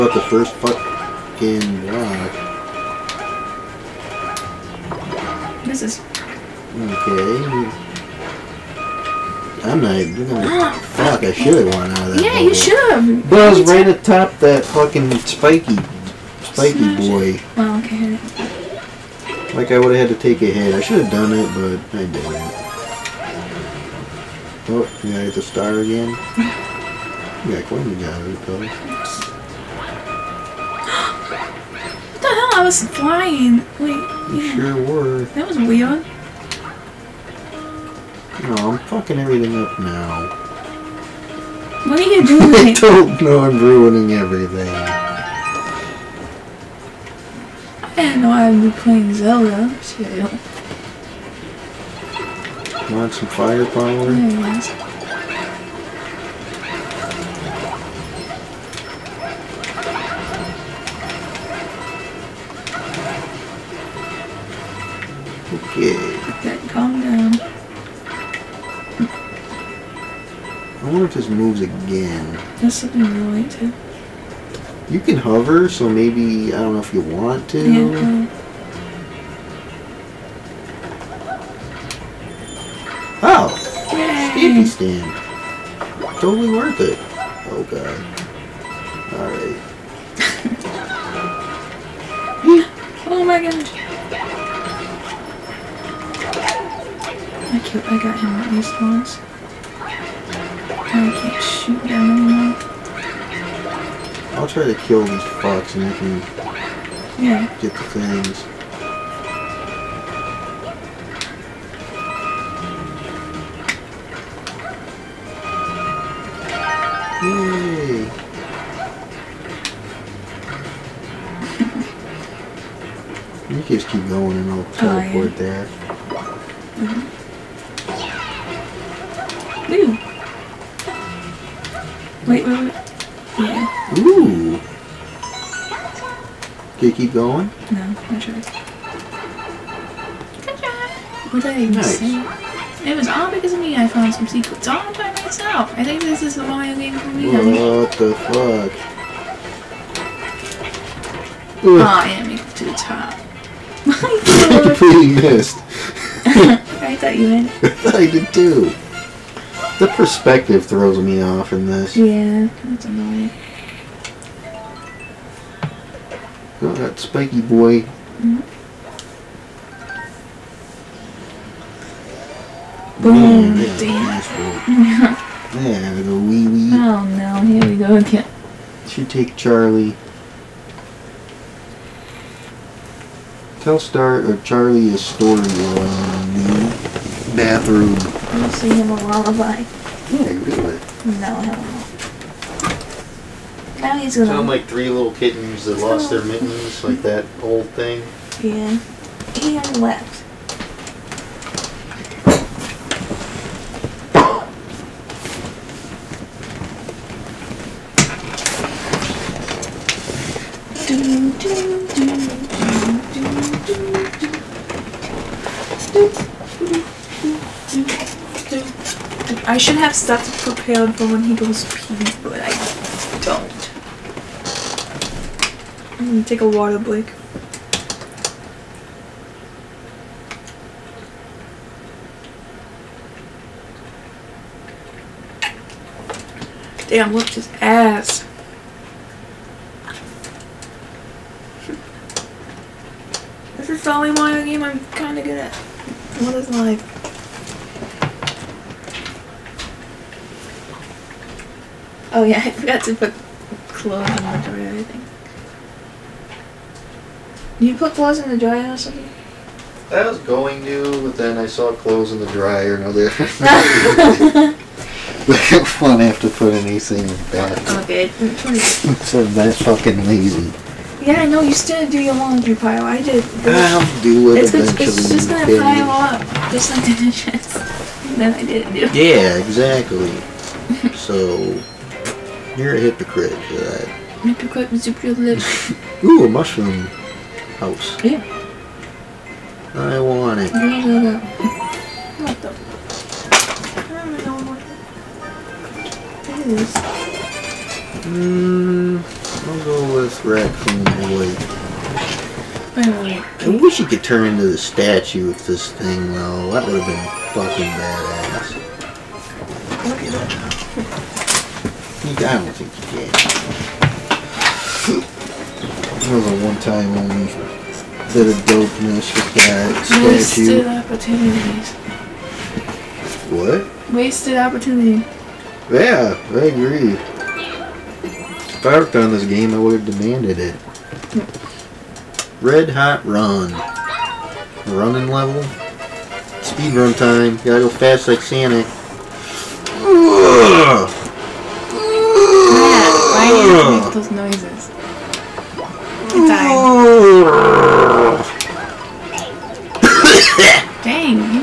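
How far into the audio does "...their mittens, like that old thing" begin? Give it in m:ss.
3:16.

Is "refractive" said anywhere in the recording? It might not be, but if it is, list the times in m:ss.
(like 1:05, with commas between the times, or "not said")
not said.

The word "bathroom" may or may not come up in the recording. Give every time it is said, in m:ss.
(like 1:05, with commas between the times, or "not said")
3:07.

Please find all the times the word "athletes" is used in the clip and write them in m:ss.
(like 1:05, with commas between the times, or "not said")
not said.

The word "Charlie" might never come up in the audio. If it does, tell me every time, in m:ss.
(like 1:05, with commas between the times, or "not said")
2:59, 3:04.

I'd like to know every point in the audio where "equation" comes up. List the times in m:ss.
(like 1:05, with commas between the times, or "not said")
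not said.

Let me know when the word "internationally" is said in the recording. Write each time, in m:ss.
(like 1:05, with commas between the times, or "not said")
not said.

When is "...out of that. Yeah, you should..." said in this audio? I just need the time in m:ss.
0:11.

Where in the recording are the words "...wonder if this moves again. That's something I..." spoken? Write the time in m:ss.
1:10.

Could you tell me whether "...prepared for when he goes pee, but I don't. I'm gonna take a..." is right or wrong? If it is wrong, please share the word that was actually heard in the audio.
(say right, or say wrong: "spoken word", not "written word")
right.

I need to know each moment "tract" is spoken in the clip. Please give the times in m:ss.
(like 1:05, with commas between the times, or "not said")
not said.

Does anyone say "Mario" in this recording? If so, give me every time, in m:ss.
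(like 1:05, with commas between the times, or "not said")
2:26, 4:04.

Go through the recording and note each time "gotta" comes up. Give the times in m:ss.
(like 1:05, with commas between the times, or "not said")
0:25, 5:37.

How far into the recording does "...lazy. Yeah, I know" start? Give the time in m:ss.
4:30.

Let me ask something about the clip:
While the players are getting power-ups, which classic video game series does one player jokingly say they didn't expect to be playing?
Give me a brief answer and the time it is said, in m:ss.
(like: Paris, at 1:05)
Zelda, at 0:49.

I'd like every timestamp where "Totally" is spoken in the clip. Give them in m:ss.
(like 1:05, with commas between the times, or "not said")
1:26.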